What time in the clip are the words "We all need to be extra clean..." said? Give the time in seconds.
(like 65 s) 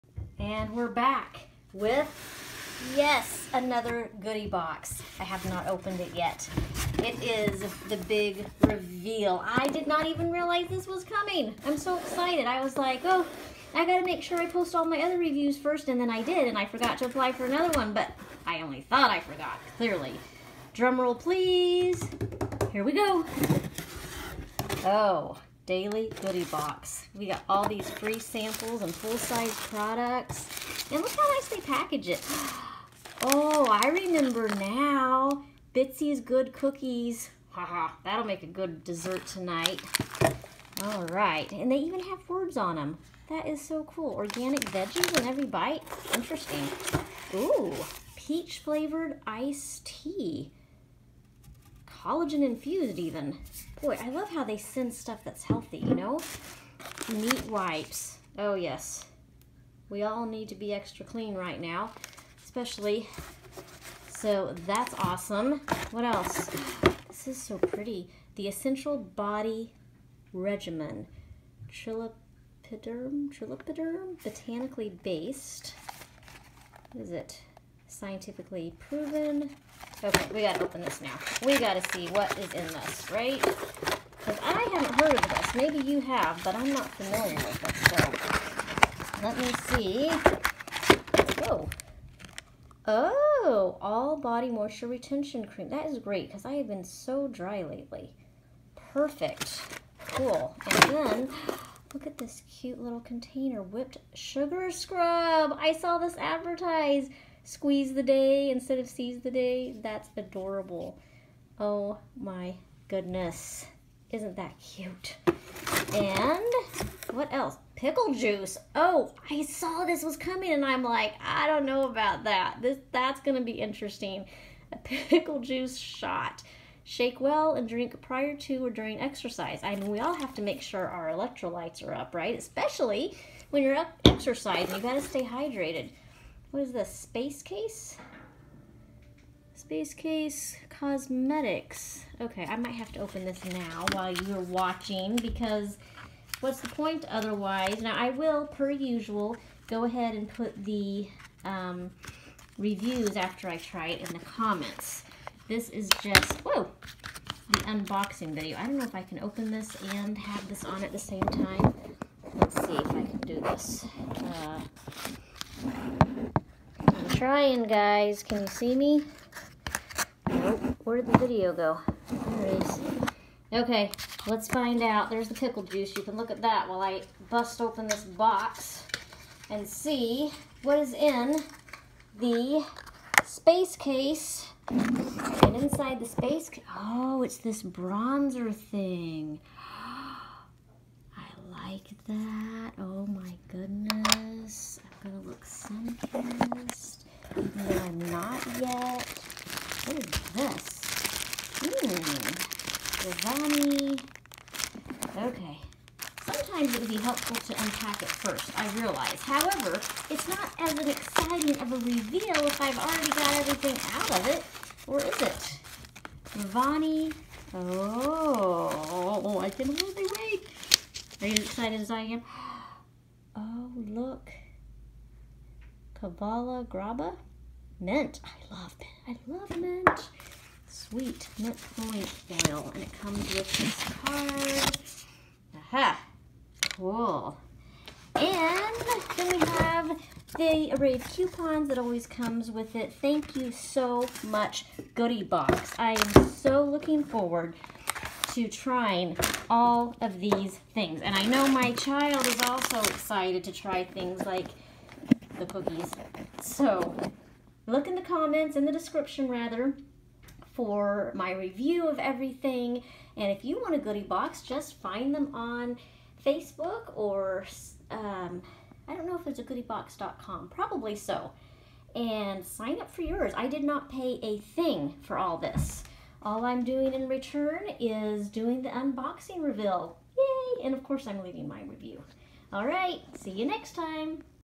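59 s.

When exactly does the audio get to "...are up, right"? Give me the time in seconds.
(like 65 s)
131 s.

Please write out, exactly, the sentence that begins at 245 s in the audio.
I am so looking forward to trying all of these things.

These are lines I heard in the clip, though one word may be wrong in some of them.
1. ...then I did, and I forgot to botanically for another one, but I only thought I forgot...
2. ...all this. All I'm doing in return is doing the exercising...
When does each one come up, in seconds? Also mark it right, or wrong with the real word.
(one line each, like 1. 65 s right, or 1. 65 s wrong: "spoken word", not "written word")
1. 16 s wrong: "apply", not "botanically"
2. 275 s wrong: "unboxing", not "exercising".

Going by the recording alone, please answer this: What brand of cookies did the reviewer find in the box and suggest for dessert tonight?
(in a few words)
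Bitsy's Good Cookies.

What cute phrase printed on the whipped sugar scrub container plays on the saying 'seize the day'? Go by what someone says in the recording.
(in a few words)
Squeeze the day.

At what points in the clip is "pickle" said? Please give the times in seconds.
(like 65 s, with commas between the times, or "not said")
117 s, 124 s, 175 s.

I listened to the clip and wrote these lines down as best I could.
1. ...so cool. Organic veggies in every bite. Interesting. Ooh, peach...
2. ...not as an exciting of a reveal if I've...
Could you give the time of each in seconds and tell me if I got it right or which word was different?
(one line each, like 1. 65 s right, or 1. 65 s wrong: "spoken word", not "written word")
1. 43 s right
2. 210 s right.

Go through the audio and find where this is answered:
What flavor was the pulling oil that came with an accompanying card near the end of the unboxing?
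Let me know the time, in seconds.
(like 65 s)
230 s.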